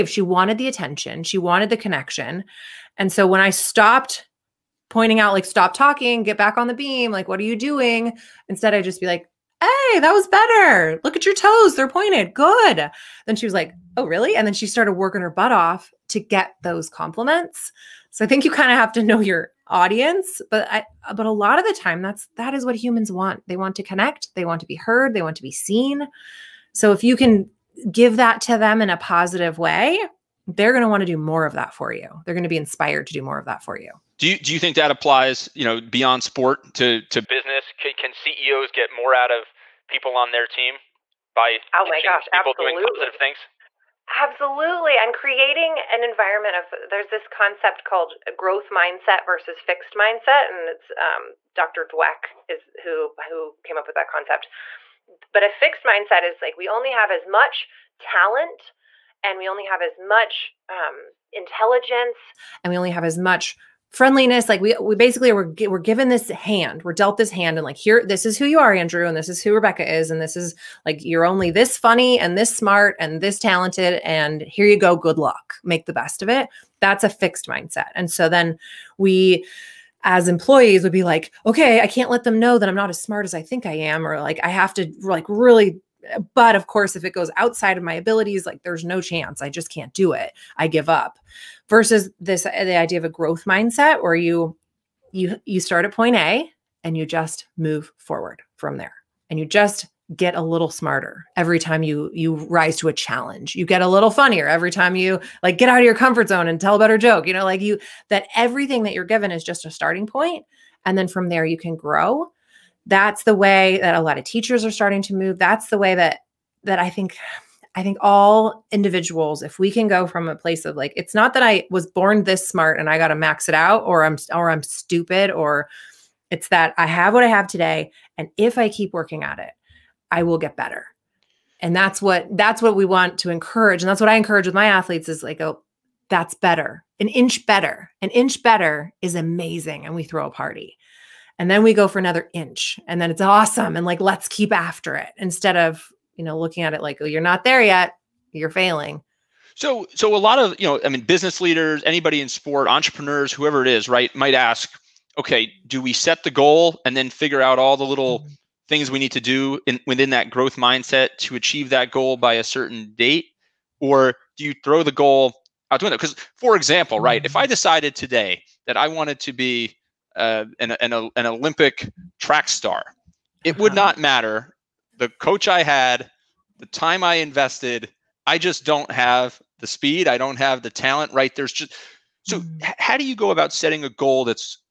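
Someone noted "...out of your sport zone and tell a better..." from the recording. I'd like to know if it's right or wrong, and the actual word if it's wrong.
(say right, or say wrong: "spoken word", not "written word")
wrong: "comfort", not "sport".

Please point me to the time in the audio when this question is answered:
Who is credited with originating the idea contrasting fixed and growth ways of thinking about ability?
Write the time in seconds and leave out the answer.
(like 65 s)
51 s.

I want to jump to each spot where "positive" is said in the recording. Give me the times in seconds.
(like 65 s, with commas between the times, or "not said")
28 s, 42 s.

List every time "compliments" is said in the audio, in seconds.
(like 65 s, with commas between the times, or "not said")
16 s.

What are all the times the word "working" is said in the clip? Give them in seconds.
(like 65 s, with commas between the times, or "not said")
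14 s, 128 s.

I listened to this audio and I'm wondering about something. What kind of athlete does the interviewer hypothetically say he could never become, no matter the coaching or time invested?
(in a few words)
Olympic track star.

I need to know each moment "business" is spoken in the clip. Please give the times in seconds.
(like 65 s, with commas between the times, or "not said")
37 s, 151 s.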